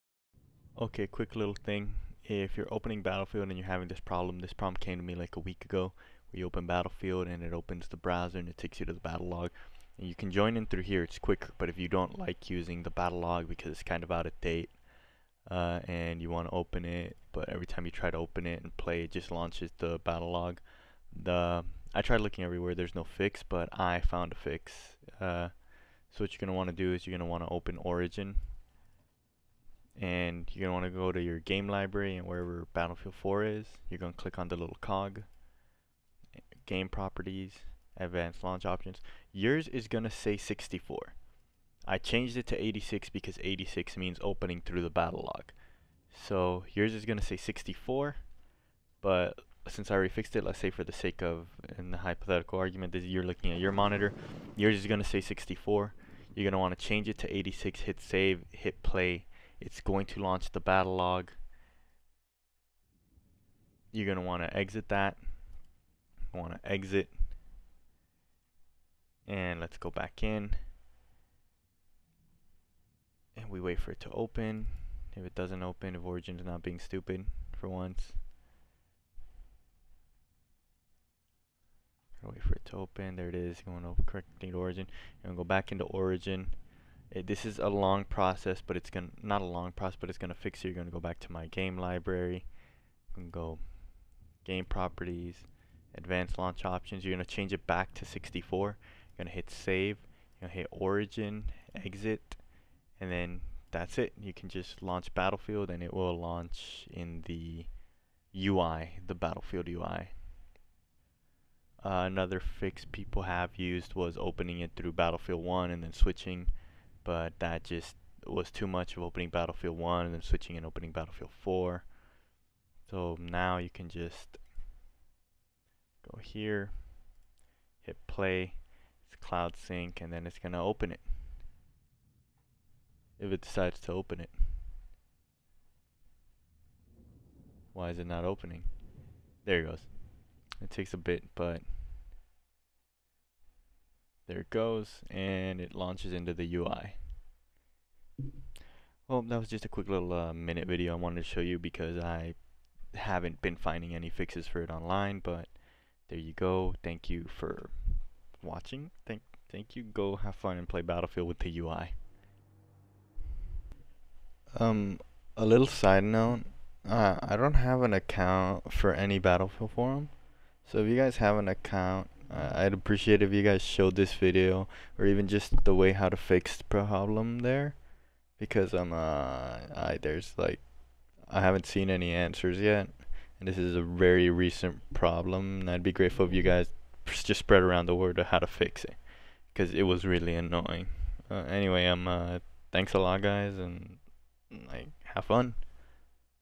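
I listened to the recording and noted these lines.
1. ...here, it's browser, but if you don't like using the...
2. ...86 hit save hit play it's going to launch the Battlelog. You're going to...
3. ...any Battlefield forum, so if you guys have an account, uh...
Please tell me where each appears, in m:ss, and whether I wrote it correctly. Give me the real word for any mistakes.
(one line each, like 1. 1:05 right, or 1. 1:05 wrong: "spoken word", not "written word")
1. 0:10 wrong: "quicker", not "browser"
2. 0:57 right
3. 2:48 right.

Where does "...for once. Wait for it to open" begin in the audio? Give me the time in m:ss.
1:17.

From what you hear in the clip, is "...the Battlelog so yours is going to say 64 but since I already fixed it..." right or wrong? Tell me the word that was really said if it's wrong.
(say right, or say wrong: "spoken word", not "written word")
right.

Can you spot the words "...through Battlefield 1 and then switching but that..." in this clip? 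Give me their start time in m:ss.
1:54.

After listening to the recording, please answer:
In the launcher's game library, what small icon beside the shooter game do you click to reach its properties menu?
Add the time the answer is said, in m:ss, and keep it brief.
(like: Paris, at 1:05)
cog, at 0:34.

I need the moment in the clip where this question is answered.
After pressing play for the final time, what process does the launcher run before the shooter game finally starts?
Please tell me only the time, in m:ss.
2:09.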